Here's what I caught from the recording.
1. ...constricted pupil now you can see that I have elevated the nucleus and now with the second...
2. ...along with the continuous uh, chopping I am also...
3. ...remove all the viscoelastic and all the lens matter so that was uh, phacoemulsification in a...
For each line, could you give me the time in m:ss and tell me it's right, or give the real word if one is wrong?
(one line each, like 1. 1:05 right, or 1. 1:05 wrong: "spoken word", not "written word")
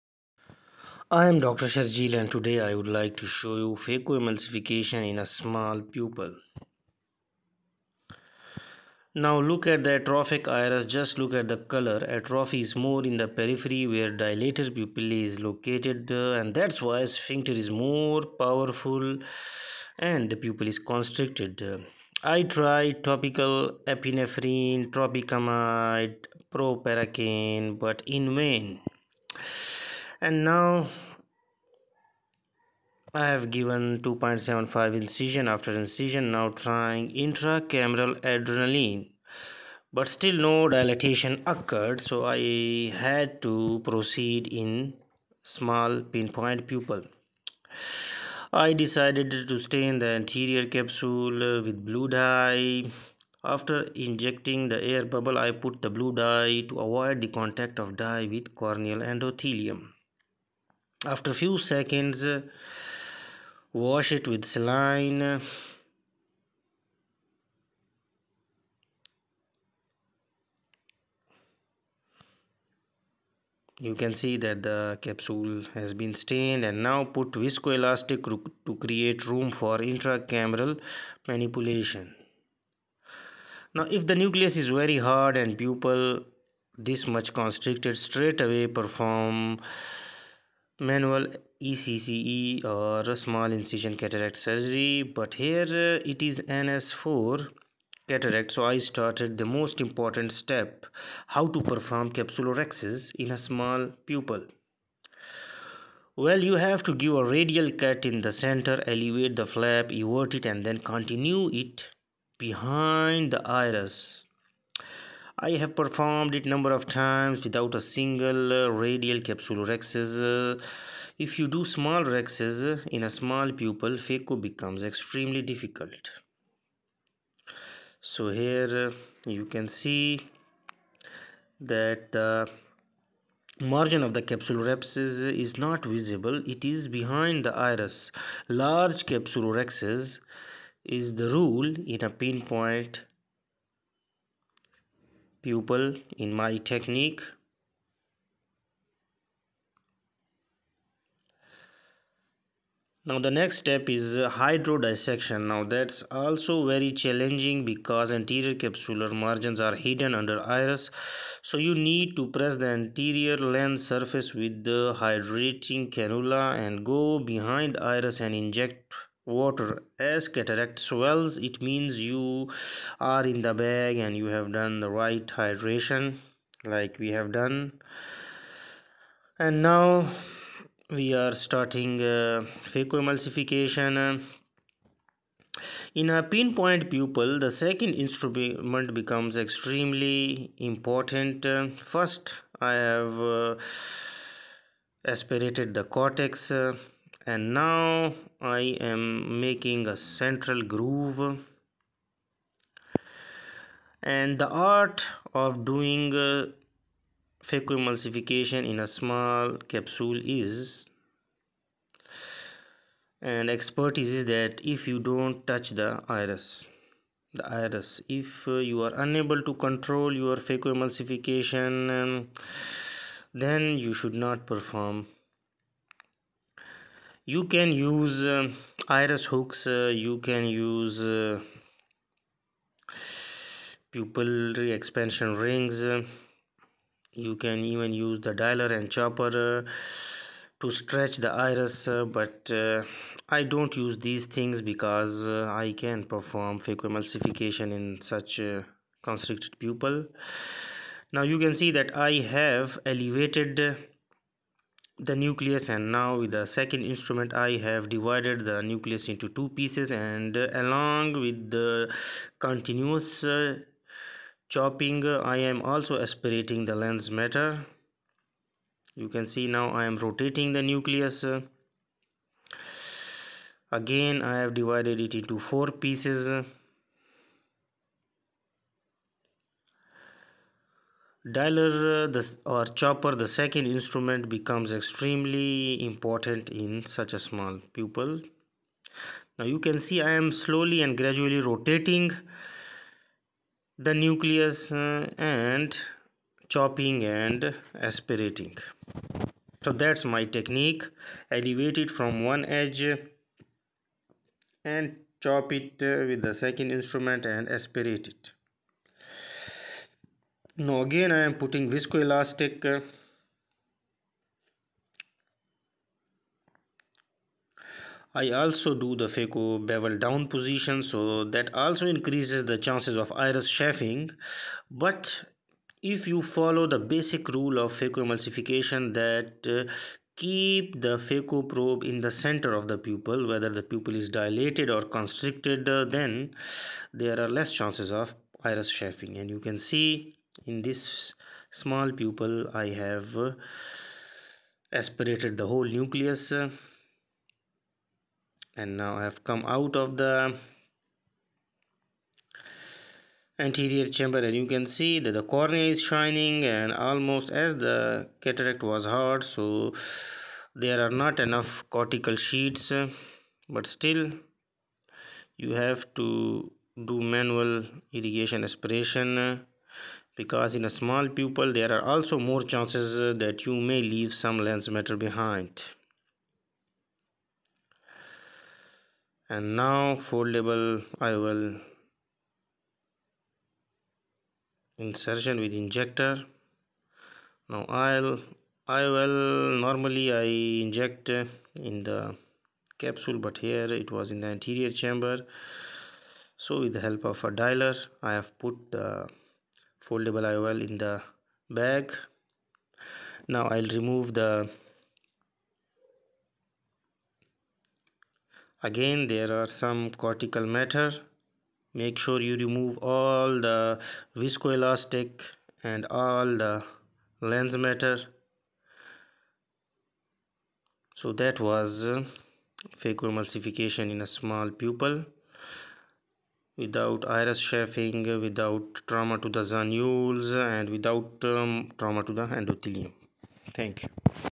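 1. 4:09 right
2. 4:20 right
3. 6:52 right.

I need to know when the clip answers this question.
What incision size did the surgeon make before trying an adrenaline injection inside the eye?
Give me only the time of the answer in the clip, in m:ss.
0:34.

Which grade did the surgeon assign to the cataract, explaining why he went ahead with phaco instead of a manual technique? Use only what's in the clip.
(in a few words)
NS4.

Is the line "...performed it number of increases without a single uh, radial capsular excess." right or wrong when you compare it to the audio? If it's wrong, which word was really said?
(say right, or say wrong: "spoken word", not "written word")
wrong: "times", not "increases".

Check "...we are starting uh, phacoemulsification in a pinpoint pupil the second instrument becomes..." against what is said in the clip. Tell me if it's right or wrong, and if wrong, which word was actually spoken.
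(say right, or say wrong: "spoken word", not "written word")
right.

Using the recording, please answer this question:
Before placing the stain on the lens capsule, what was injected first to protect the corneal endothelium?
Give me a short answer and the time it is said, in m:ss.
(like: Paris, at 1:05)
air bubble, at 0:54.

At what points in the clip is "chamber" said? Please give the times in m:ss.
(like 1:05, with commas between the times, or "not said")
5:53, 6:34.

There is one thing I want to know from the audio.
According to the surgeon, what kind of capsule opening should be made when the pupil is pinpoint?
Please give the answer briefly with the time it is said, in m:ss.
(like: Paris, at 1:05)
Large capsulorhexis, at 2:18.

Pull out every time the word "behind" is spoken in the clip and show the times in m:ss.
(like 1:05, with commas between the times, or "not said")
1:52, 2:16, 2:47, 6:14.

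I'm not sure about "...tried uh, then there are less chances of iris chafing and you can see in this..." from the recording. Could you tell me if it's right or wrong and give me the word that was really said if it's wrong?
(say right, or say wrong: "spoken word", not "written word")
wrong: "constricted", not "tried".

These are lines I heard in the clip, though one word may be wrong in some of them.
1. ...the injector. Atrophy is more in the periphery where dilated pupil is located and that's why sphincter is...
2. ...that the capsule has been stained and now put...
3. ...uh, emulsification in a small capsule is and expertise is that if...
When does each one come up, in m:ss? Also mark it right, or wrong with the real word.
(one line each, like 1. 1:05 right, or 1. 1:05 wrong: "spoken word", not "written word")
1. 0:11 wrong: "color", not "injector"
2. 1:14 right
3. 3:27 right.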